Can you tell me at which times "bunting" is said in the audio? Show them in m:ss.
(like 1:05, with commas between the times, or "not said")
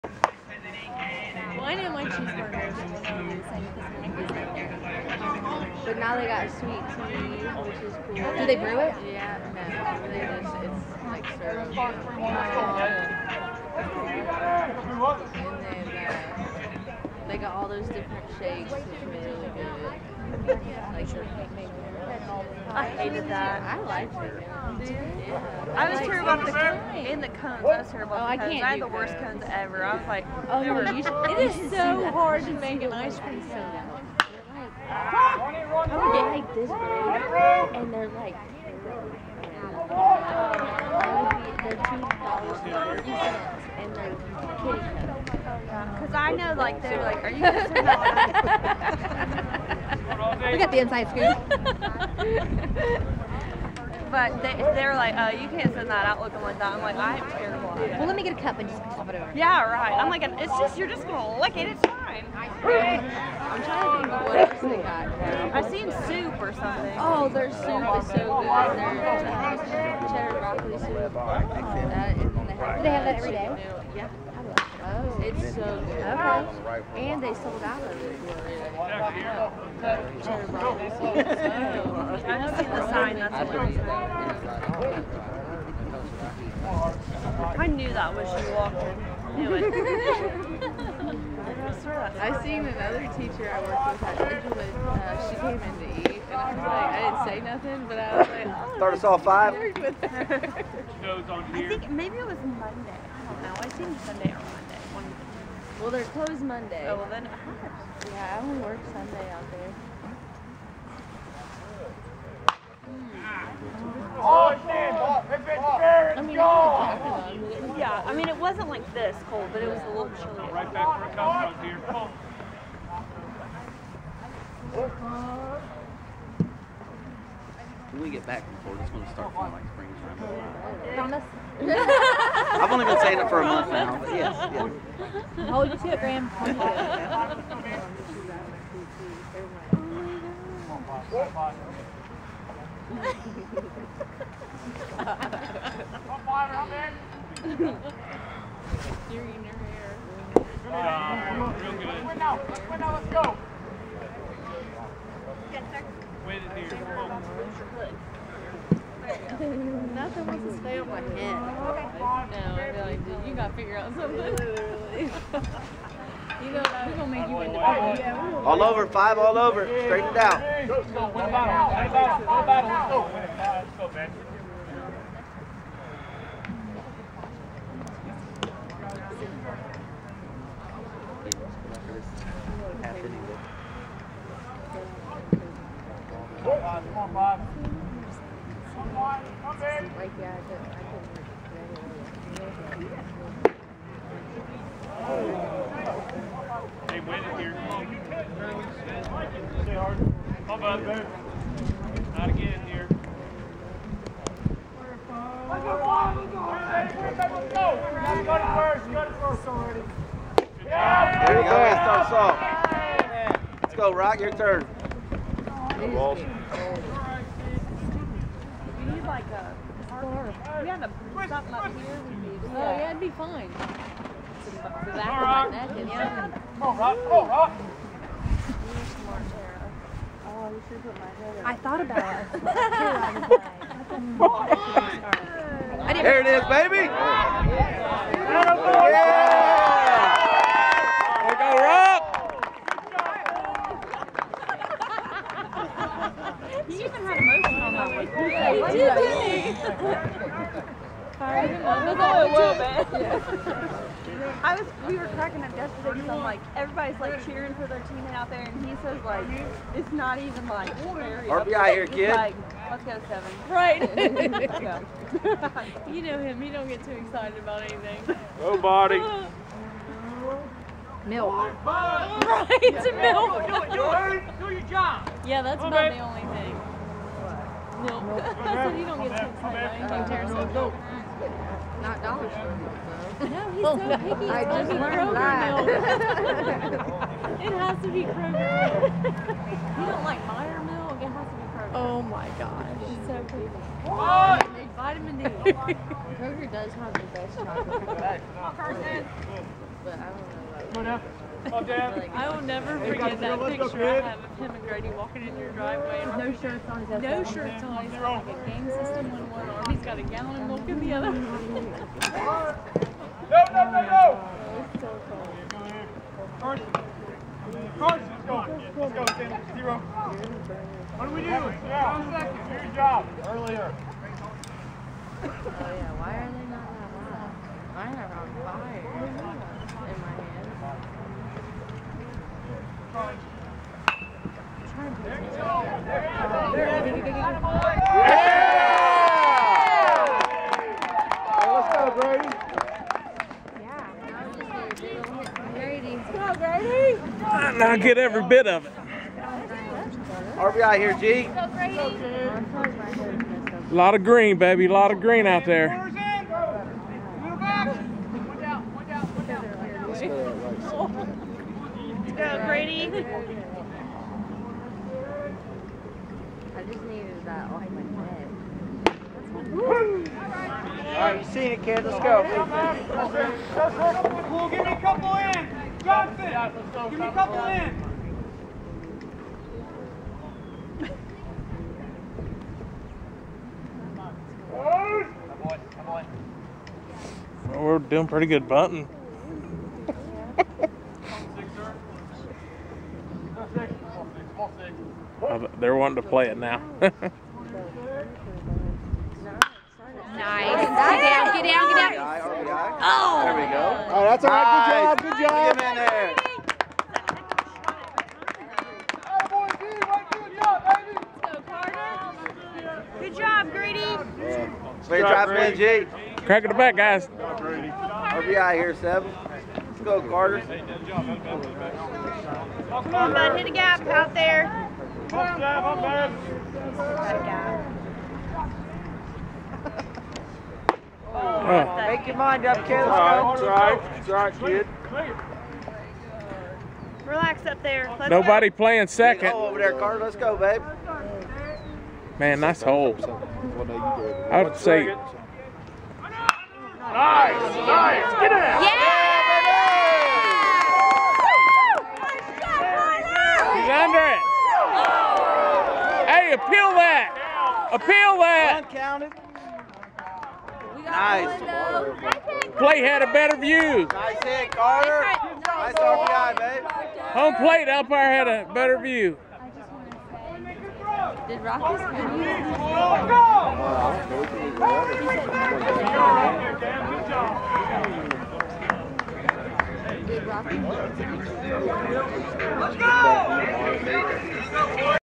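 6:28.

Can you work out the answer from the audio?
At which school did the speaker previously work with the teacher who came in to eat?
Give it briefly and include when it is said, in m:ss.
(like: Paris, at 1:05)
Edgewood, at 1:34.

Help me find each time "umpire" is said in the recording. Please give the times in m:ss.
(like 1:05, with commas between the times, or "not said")
7:47.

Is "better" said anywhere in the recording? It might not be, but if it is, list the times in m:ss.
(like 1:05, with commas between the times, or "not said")
7:43, 7:48.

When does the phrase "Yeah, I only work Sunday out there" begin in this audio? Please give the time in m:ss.
1:48.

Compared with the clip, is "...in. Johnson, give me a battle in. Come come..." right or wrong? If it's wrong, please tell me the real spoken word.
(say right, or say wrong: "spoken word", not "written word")
wrong: "couple", not "battle".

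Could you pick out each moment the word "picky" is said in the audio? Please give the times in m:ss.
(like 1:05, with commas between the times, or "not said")
4:43, 4:53.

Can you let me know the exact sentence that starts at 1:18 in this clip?
I don't see the sign, that's what I knew that was you walked in.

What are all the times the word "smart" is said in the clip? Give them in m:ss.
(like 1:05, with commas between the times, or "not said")
3:48.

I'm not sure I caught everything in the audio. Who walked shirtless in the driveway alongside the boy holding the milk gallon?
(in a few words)
Grady.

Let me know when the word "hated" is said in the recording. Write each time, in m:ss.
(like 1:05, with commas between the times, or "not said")
0:22.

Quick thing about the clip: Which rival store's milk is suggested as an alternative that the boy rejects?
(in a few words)
Meijer.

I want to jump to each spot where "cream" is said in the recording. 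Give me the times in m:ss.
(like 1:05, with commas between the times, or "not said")
0:33.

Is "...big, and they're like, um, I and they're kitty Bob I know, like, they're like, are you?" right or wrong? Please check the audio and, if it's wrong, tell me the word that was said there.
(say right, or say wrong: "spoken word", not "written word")
wrong: "Because", not "Bob".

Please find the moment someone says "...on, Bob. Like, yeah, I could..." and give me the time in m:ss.
3:06.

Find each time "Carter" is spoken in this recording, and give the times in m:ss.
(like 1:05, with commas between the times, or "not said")
7:00, 7:19, 7:44.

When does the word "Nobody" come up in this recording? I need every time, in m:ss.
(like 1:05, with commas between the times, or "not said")
4:28, 7:18.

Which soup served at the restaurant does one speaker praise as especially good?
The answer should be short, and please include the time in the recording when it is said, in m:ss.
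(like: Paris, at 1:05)
Cheddar broccoli, at 1:09.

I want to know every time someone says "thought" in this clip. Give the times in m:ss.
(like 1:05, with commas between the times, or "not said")
3:51.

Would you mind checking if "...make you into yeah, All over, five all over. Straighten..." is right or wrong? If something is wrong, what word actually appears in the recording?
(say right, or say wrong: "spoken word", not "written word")
right.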